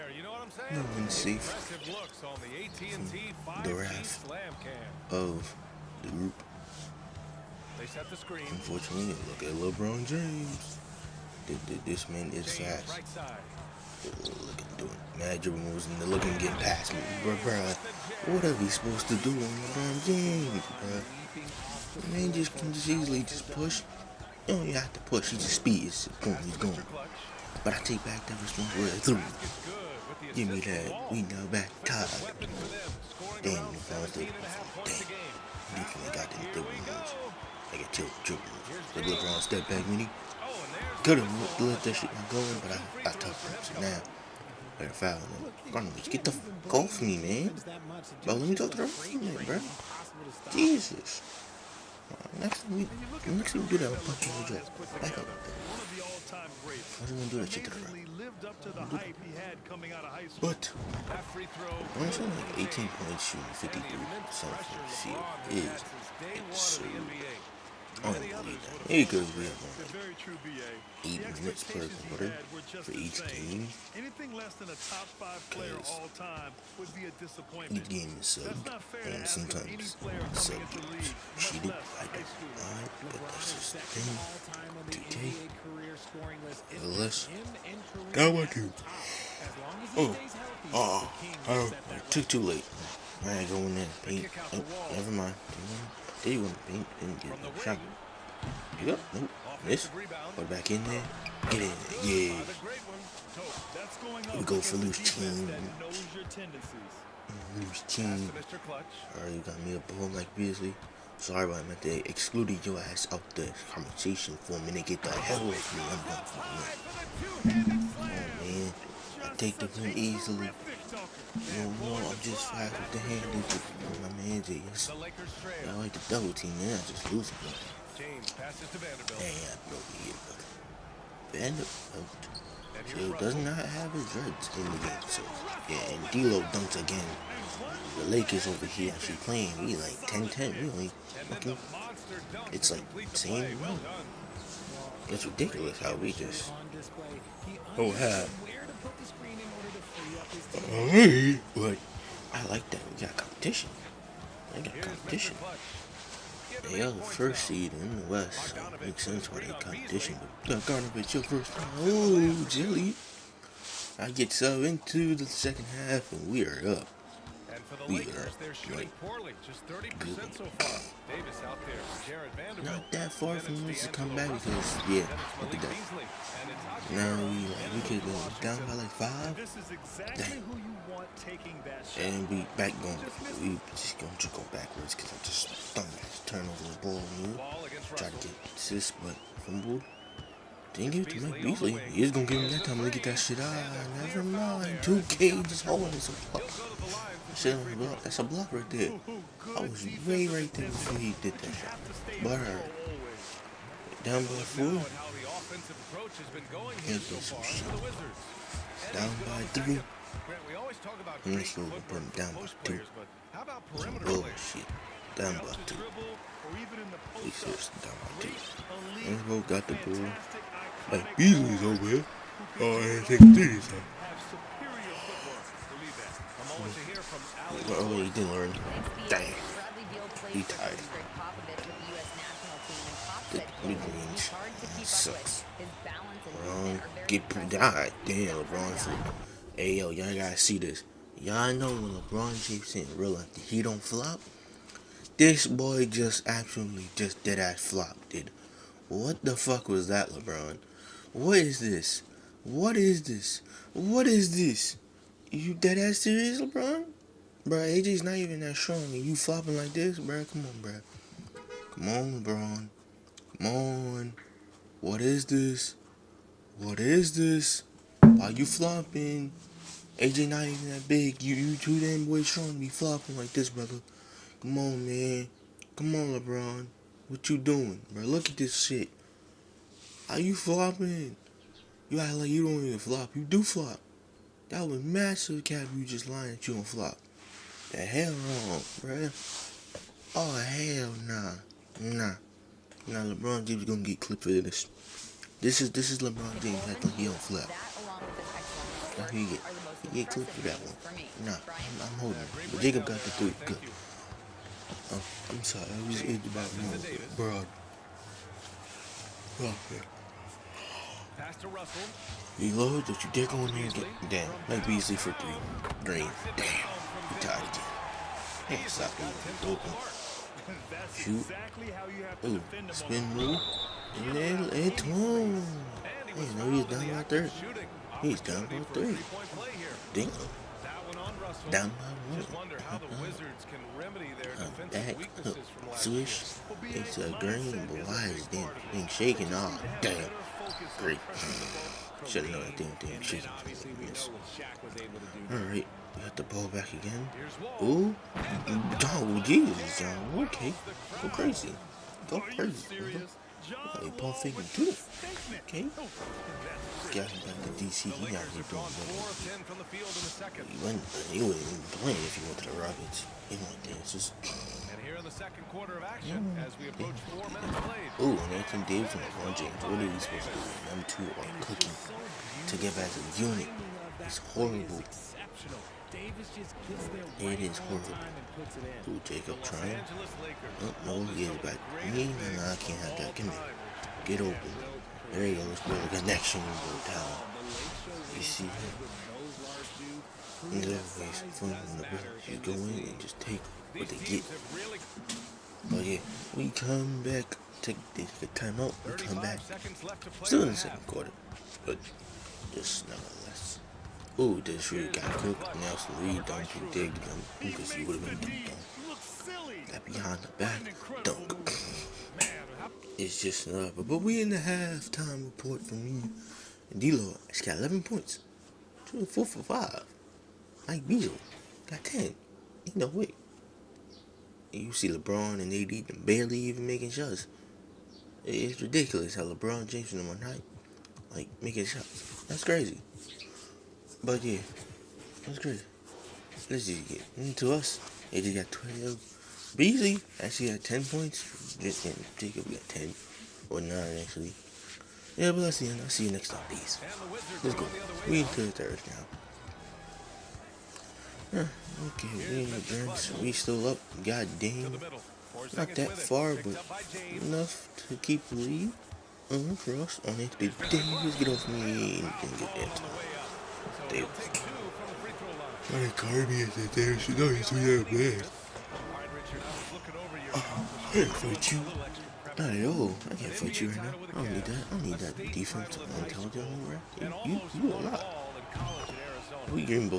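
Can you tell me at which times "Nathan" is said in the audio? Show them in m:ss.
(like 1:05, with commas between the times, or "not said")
6:08.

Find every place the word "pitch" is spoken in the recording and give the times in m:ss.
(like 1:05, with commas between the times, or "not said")
not said.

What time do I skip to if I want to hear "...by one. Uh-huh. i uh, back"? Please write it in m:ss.
5:31.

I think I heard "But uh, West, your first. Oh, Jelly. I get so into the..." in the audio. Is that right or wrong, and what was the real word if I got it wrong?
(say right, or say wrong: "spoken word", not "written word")
wrong: "Garnovich", not "West".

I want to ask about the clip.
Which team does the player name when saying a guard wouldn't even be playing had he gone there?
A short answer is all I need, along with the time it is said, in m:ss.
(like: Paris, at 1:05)
Rockets, at 6:02.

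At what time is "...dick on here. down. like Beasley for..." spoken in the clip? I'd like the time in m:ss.
5:13.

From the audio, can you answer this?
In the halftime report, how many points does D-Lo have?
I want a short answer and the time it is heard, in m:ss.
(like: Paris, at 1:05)
11, at 6:57.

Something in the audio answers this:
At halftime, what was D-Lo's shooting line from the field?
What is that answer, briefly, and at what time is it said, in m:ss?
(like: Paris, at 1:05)
4 for 5, at 6:58.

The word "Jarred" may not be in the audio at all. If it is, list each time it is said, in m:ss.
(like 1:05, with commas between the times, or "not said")
2:52.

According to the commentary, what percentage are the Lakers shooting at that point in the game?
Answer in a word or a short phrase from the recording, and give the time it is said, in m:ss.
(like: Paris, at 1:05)
30%, at 2:49.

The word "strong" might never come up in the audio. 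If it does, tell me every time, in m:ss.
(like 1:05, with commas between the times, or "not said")
4:18, 4:32.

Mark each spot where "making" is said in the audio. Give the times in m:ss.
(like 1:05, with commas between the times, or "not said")
7:06, 7:11.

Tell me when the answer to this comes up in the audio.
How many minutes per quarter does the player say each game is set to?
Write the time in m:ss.
1:11.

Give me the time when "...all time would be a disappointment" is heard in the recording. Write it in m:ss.
1:15.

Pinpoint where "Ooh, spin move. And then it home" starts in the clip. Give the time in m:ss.
5:22.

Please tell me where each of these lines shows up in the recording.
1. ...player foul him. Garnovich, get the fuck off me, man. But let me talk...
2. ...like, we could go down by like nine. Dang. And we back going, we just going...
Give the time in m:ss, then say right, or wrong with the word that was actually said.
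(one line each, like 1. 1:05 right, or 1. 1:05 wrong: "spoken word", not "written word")
1. 0:44 wrong: "better", not "player"
2. 2:57 wrong: "five", not "nine".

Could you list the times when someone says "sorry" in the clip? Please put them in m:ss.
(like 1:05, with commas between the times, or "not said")
1:51, 5:05.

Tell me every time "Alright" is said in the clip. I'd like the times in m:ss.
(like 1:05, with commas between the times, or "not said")
1:49, 5:45.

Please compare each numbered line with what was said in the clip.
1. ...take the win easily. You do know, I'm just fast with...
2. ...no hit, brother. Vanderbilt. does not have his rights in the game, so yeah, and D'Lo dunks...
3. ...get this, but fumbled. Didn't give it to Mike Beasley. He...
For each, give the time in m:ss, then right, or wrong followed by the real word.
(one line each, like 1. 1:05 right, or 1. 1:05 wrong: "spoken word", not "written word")
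1. 1:59 right
2. 2:09 right
3. 3:08 right.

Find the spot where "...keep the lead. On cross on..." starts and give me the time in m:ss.
7:37.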